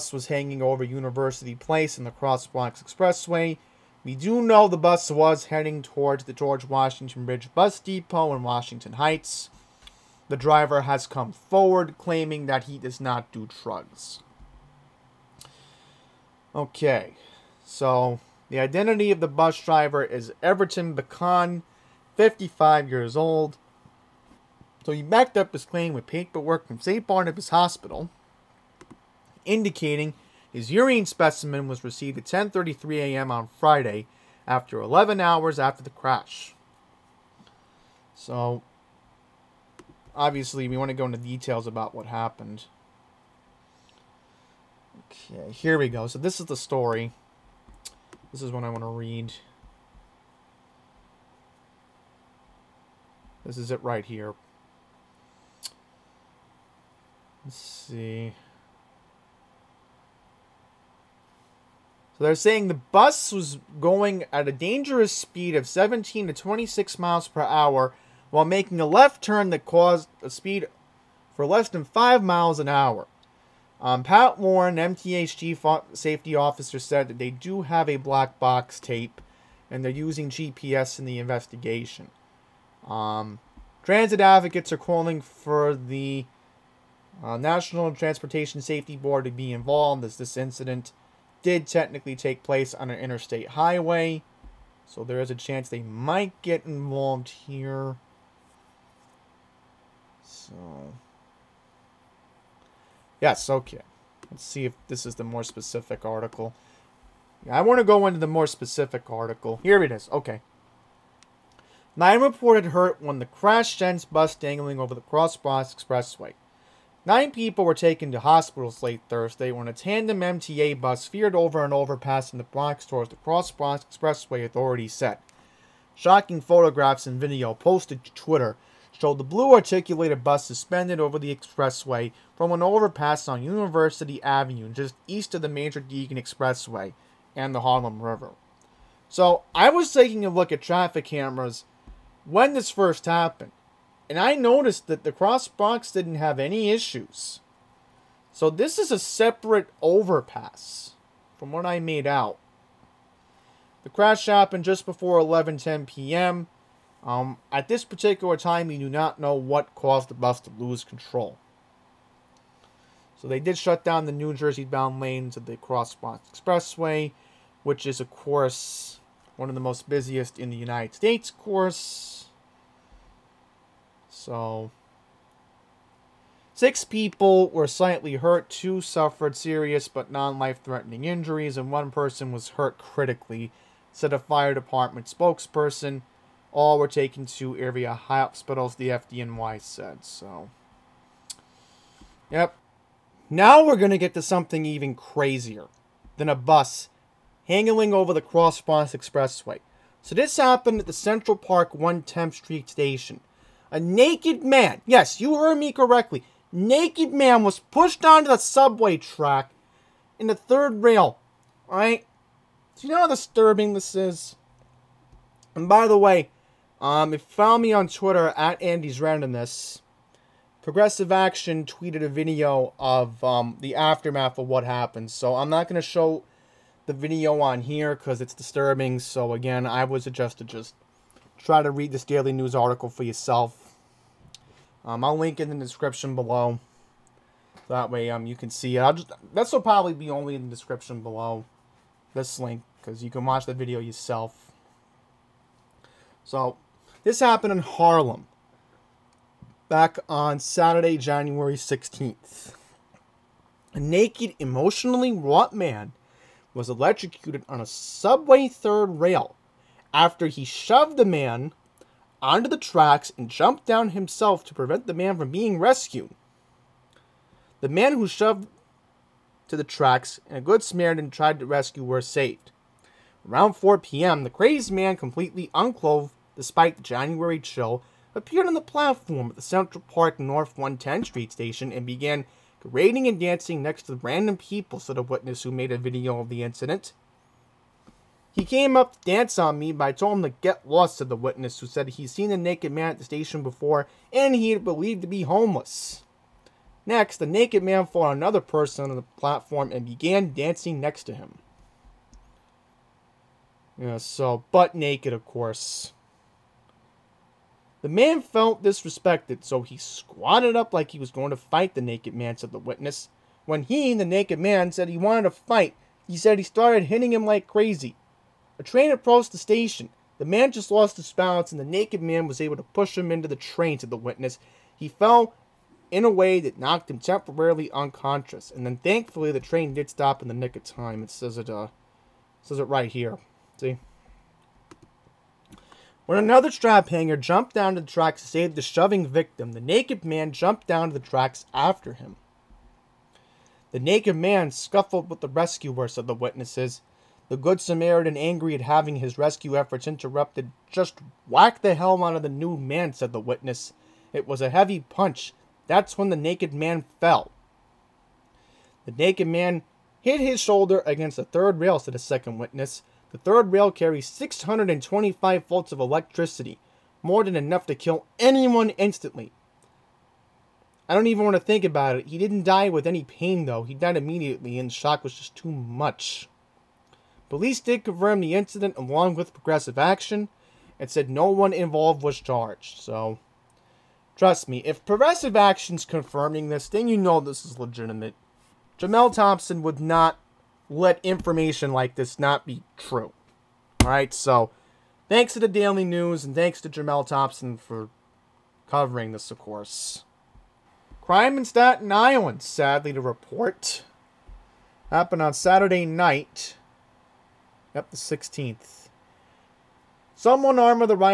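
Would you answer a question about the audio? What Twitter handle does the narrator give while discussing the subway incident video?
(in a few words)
Andy's Randomness.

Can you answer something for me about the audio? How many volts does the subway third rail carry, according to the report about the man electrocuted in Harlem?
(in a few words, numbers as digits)
625.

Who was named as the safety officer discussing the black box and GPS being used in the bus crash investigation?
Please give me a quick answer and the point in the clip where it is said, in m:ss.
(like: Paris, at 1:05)
Pat Warren, at 1:14.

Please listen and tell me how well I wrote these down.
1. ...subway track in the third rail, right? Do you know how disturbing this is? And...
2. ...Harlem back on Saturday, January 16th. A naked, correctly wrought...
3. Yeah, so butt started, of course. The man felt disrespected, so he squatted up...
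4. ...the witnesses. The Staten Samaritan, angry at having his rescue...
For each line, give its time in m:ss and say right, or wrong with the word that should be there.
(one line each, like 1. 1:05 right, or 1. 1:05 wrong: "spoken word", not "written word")
1. 3:28 right
2. 4:07 wrong: "emotionally", not "correctly"
3. 5:03 wrong: "naked", not "started"
4. 5:46 wrong: "Good", not "Staten".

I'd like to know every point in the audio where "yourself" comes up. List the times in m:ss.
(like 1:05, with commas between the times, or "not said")
3:53, 4:03.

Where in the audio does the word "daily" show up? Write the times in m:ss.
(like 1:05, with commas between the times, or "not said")
3:52, 6:35.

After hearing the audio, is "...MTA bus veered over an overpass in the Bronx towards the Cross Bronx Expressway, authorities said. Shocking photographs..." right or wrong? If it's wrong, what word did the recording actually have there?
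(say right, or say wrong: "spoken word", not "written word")
right.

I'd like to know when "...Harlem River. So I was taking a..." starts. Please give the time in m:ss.
2:17.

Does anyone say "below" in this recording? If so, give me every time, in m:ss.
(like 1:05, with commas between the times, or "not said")
3:56, 4:01.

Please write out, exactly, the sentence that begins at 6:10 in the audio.
I don't even want to think about it.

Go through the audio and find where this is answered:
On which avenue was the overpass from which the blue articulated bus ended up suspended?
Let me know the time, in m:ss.
2:13.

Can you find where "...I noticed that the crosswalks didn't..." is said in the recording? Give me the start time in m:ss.
2:24.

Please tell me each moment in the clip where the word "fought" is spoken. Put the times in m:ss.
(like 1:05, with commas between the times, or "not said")
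4:57.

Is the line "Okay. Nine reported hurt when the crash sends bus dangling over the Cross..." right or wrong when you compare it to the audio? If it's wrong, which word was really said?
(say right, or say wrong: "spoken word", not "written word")
right.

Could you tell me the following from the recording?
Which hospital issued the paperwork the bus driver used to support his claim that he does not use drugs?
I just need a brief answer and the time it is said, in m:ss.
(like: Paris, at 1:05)
St. Barnabas Hospital, at 0:26.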